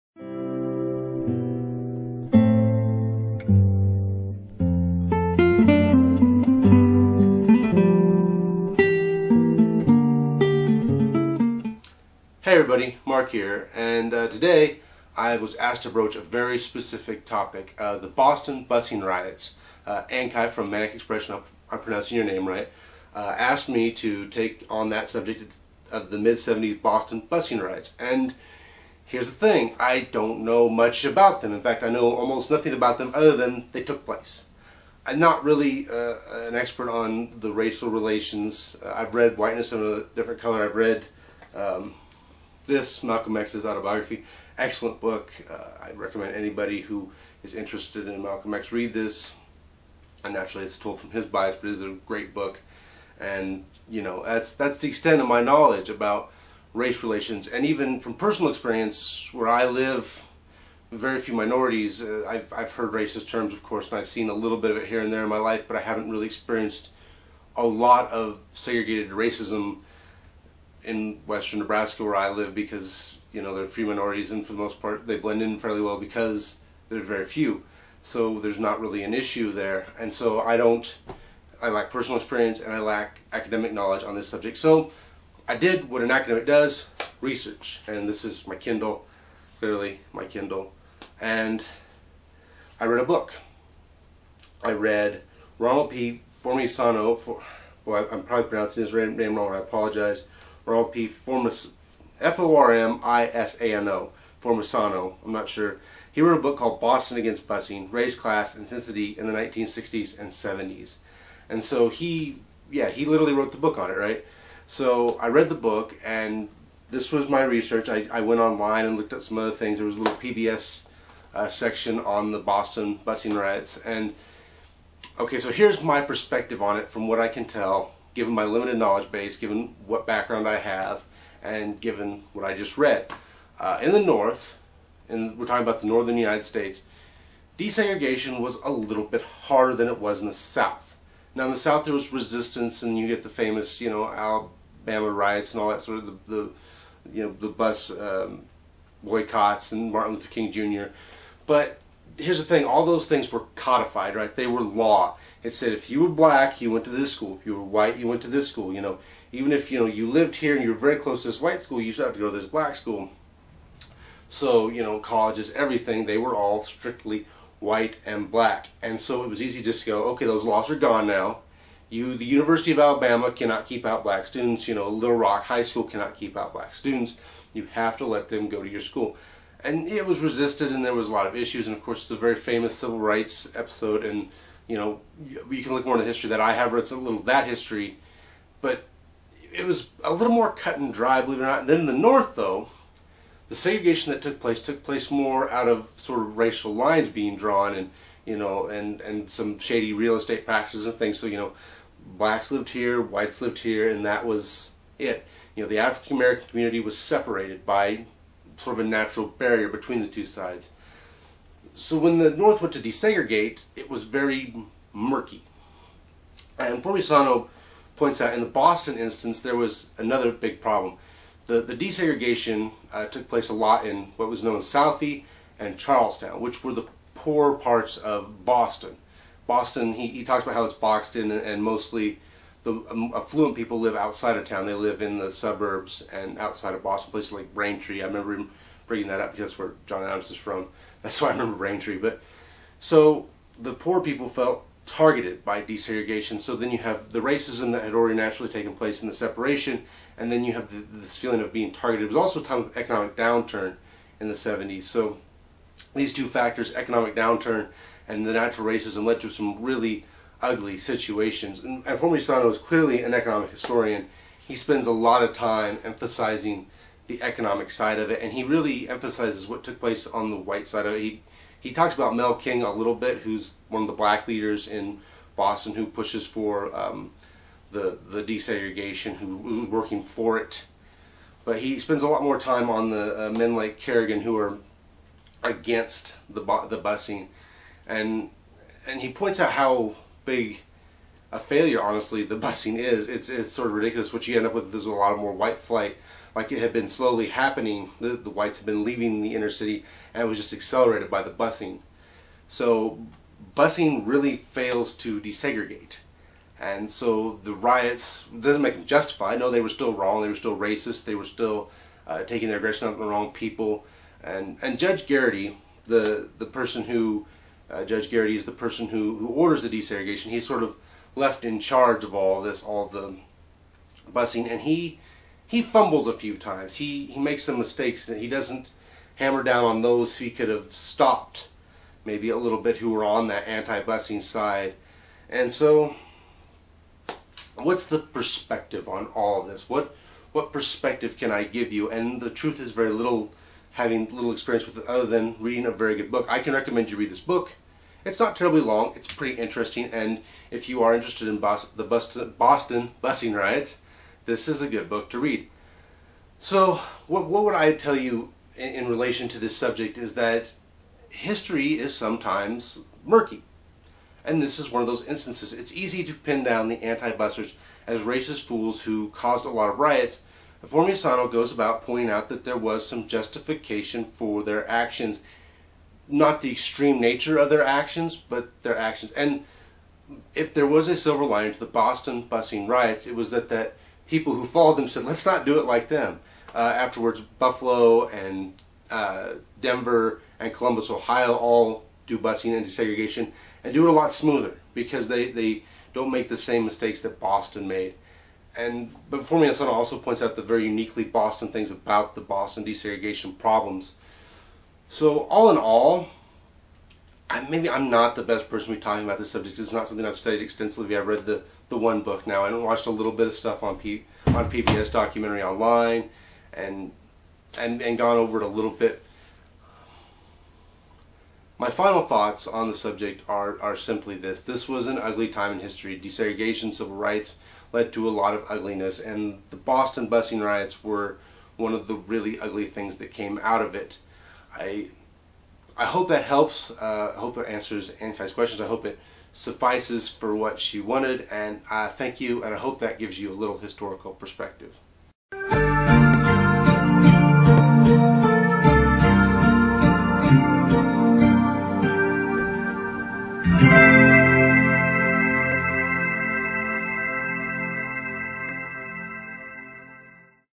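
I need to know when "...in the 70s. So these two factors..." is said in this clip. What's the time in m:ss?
4:14.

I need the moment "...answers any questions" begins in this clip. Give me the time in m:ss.
7:17.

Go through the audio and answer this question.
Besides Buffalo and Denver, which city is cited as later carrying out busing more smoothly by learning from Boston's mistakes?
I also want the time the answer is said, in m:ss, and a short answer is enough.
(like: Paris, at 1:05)
Columbus, Ohio, at 6:30.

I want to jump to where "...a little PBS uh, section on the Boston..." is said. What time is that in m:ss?
1:59.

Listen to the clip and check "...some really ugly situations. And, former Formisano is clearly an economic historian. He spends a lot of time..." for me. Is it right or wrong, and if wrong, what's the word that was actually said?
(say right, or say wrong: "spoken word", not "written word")
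right.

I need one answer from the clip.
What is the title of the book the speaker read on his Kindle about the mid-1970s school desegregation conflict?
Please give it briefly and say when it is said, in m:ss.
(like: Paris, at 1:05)
Boston Against Busing, at 1:46.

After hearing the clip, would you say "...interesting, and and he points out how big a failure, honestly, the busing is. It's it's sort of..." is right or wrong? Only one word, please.
wrong.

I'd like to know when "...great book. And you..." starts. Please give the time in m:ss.
0:52.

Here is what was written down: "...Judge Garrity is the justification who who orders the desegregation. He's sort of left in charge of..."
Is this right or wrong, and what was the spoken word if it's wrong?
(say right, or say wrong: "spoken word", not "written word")
wrong: "person", not "justification".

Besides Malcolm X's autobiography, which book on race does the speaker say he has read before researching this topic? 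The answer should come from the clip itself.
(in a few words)
Whiteness of a Different Color.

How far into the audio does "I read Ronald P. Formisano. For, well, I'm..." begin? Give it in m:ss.
1:34.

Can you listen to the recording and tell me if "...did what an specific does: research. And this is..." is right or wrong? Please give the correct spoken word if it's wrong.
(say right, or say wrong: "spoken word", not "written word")
wrong: "academic", not "specific".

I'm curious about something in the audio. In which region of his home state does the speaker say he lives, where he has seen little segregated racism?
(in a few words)
western Nebraska.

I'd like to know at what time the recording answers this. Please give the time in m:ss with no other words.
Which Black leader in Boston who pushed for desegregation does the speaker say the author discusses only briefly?
4:32.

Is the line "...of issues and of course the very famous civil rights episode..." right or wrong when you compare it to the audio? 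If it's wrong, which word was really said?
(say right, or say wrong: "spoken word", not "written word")
right.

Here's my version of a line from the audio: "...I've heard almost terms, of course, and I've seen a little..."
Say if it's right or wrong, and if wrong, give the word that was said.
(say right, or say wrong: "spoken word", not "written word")
wrong: "racist", not "almost".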